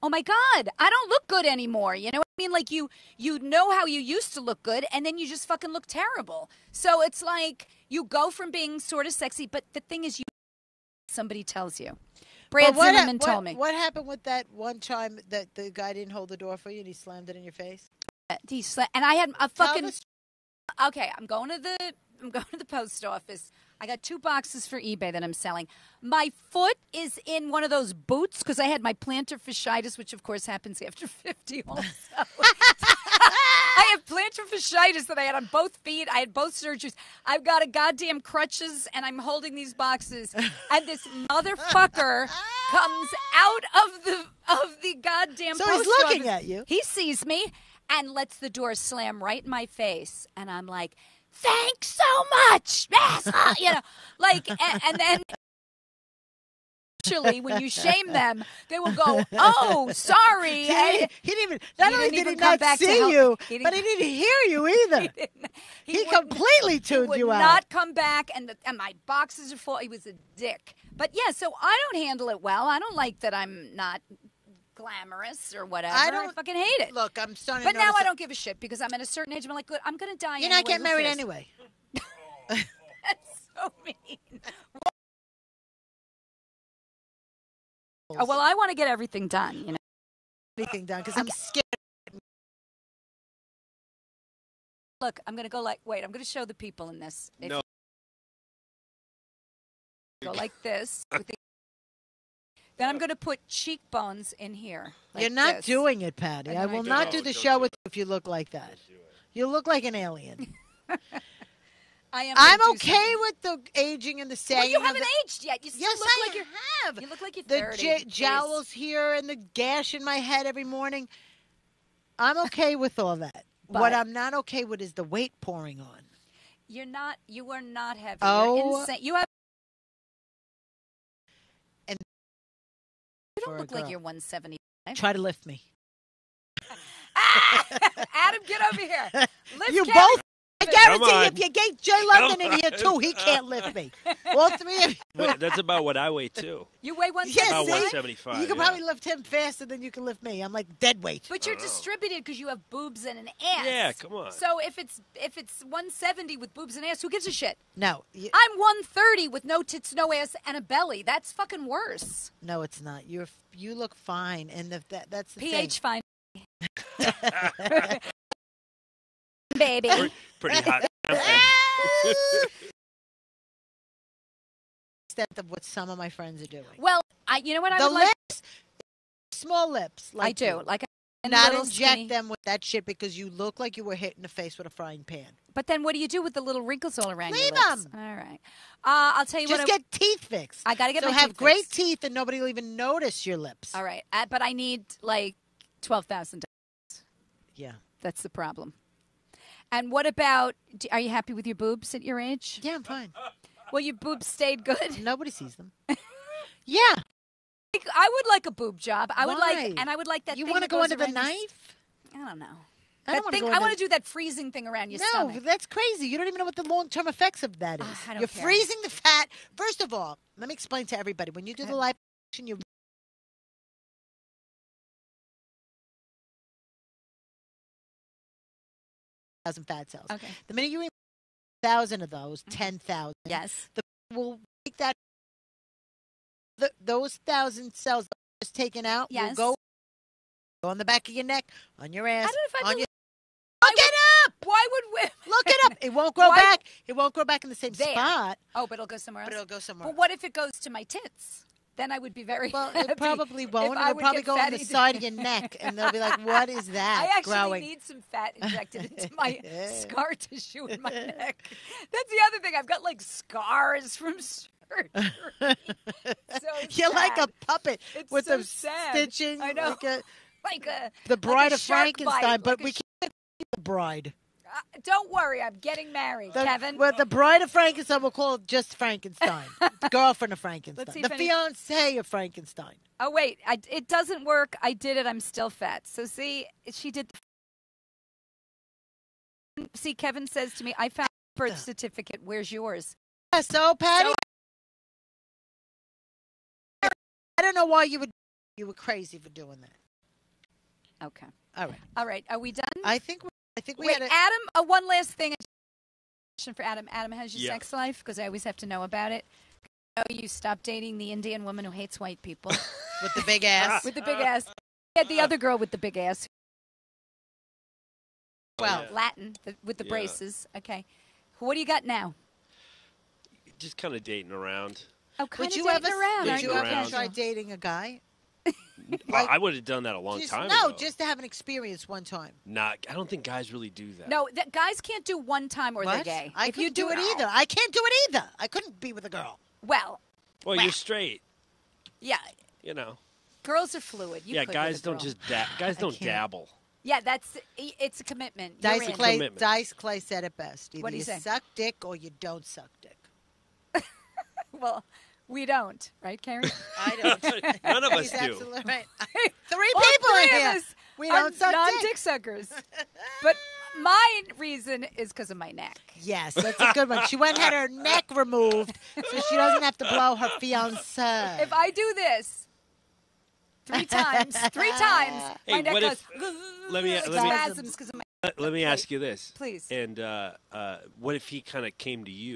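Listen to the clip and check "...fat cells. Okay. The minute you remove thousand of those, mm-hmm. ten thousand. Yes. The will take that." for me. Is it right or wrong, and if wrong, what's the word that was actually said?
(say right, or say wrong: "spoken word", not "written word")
right.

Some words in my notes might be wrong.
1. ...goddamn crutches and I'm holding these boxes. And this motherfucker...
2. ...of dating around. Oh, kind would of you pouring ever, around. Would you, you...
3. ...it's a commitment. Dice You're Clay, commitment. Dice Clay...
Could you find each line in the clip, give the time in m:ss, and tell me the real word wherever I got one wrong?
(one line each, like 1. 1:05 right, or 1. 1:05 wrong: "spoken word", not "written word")
1. 0:37 right
2. 5:23 wrong: "dating", not "pouring"
3. 5:47 right.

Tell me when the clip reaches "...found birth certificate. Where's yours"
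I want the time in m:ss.
4:50.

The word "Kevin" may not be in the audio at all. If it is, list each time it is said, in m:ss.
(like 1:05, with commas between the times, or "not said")
4:36, 4:49.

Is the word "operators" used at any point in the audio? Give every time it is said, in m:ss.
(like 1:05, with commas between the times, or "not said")
not said.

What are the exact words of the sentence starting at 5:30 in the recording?
just to have an experience one time.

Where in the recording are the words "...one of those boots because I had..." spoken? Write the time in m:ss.
0:27.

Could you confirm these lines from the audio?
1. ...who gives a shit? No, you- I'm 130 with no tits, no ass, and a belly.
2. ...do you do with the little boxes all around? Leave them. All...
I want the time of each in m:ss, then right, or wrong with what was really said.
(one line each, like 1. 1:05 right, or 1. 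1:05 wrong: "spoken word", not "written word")
1. 2:37 right
2. 3:05 wrong: "wrinkles", not "boxes".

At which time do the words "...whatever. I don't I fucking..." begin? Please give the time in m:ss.
1:15.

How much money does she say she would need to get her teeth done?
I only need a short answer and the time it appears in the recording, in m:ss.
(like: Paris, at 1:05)
$12,000, at 3:15.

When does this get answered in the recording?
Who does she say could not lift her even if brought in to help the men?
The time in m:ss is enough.
2:21.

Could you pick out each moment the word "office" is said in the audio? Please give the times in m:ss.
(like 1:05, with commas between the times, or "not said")
0:23, 0:46.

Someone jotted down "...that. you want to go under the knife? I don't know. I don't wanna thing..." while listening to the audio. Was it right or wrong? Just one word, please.
right.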